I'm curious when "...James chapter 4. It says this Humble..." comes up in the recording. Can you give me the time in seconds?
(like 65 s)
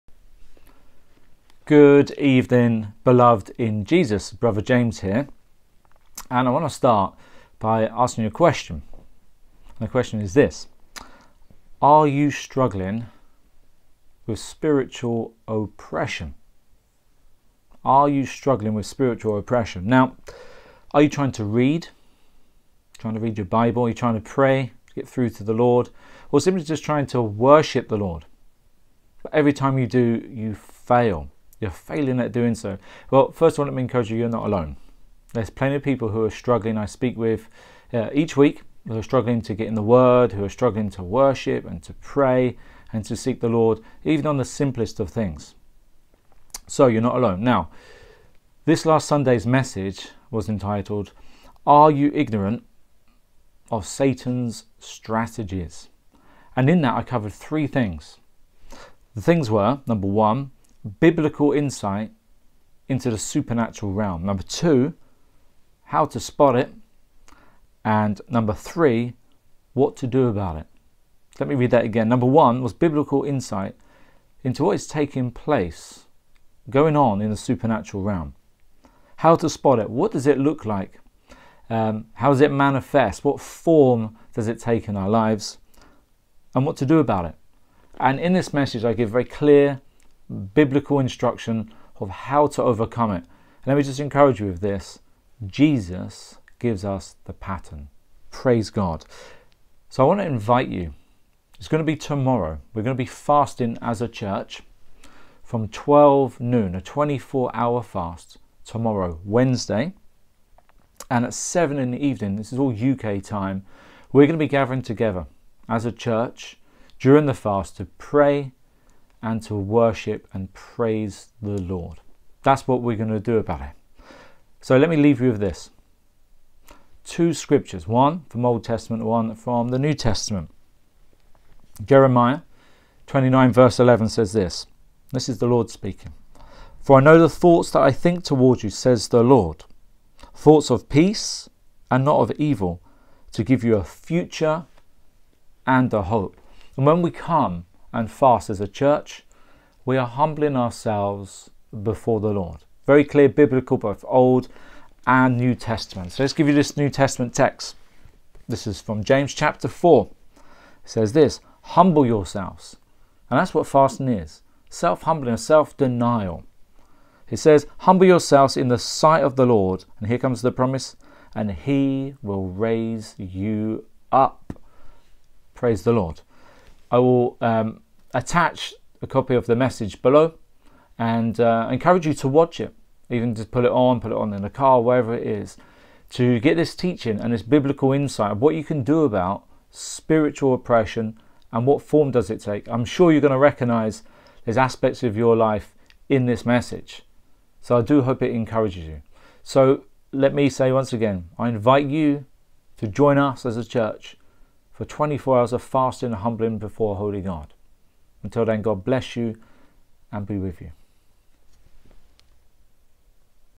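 159 s.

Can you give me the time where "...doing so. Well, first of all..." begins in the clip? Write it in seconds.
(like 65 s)
32 s.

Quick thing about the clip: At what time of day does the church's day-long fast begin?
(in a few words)
12 noon.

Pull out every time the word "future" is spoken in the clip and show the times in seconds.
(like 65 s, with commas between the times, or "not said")
143 s.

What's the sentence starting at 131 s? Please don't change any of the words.
Jeremiah 29, verse 11 says this This is the Lord speaking.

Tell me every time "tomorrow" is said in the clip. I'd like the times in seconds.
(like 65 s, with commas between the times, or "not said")
101 s, 108 s.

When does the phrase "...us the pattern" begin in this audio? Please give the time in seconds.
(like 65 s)
96 s.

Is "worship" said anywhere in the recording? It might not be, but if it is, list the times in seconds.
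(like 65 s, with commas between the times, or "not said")
27 s, 41 s, 119 s.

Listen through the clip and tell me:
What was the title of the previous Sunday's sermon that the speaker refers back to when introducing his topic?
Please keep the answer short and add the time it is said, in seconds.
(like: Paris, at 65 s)
Are You Ignorant of Satan's Strategies?, at 51 s.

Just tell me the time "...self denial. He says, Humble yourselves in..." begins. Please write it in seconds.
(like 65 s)
165 s.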